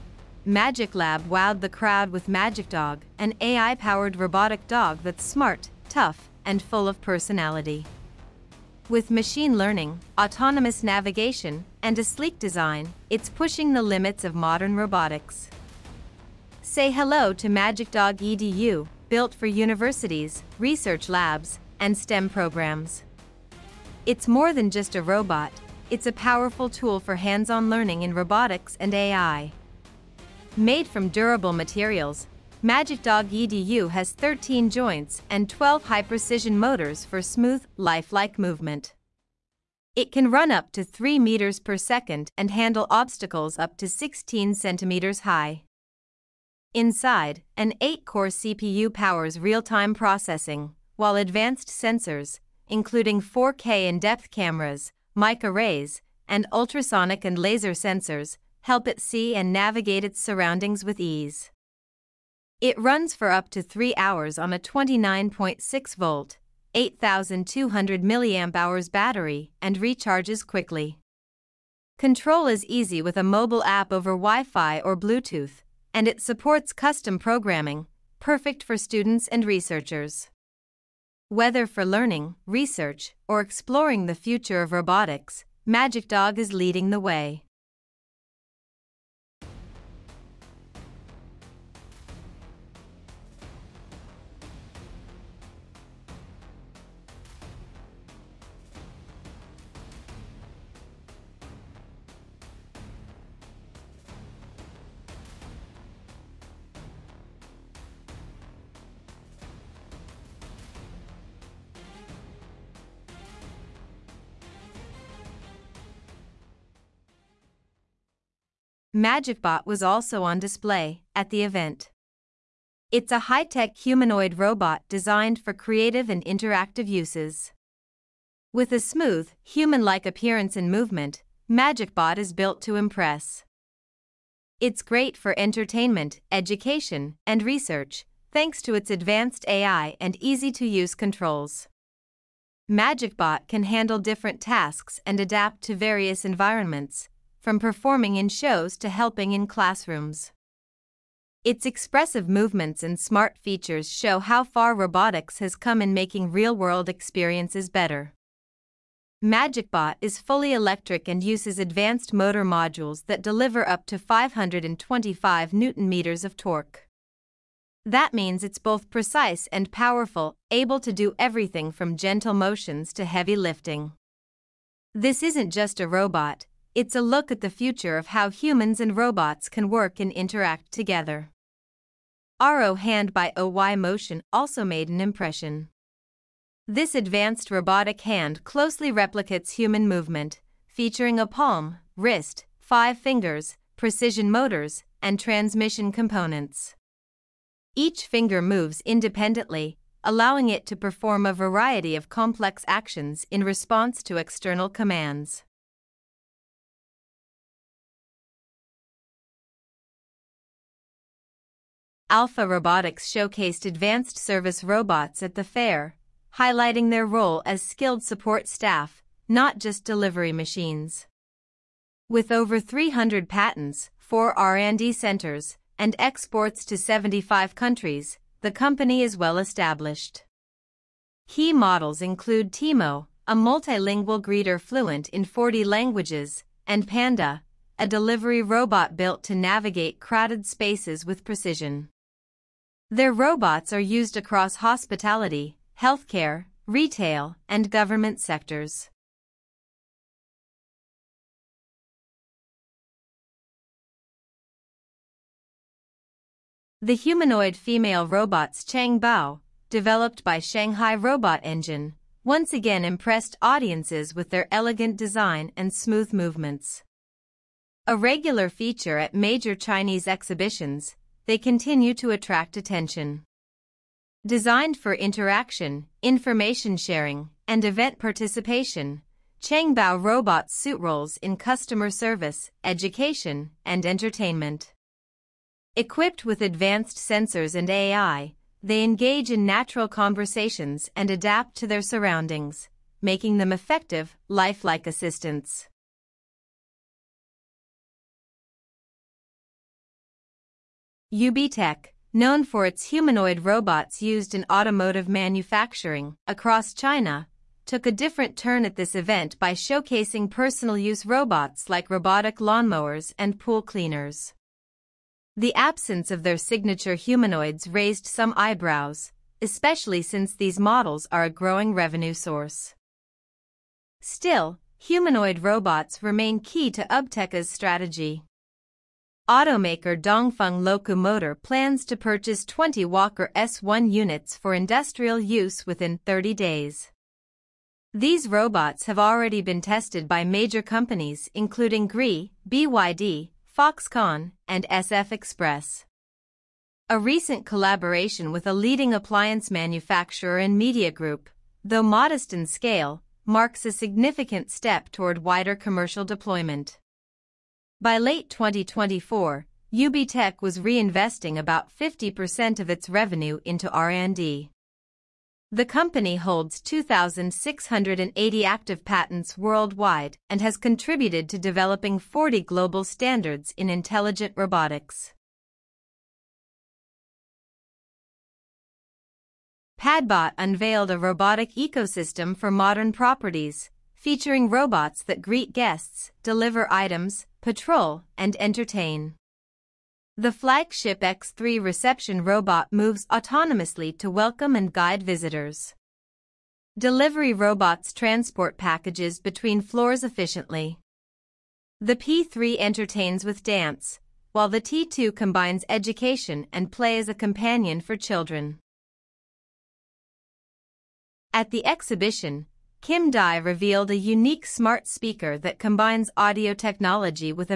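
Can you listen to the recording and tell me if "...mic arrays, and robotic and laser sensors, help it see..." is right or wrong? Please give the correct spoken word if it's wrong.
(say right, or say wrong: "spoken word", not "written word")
wrong: "ultrasonic", not "robotic".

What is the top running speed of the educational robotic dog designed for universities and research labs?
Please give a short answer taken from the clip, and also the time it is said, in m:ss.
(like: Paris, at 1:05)
3 meters per second, at 0:40.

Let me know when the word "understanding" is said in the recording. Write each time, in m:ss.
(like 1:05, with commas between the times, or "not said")
not said.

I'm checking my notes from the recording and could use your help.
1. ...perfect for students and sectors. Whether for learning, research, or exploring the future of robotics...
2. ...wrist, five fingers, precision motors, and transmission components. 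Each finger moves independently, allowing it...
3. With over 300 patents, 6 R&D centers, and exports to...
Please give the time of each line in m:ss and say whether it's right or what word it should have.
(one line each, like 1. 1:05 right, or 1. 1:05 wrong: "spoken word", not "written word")
1. 1:18 wrong: "researchers", not "sectors"
2. 3:11 right
3. 3:42 wrong: "4", not "6".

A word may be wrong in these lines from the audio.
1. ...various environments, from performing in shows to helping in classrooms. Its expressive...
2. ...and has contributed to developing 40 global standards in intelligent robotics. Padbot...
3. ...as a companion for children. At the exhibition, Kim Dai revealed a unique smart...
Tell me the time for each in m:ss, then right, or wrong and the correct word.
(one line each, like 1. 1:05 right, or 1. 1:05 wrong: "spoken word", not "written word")
1. 2:25 right
2. 6:10 right
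3. 6:46 right.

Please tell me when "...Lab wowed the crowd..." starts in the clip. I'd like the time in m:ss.
0:00.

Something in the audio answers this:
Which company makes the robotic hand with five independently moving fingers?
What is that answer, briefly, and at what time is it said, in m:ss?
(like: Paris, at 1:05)
OYMotion, at 3:03.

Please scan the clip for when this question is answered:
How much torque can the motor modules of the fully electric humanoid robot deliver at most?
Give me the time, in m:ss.
2:43.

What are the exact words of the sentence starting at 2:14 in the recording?
It's great for entertainment, education, and research, thanks to its advanced AI and easy-to-use controls.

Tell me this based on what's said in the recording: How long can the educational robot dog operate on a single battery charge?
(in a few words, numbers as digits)
3 hours.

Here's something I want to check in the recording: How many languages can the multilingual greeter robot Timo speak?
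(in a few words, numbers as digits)
40.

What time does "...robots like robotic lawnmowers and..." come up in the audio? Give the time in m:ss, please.
5:11.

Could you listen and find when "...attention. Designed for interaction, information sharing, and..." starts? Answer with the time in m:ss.
4:32.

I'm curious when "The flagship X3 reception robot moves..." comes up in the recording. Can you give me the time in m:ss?
6:30.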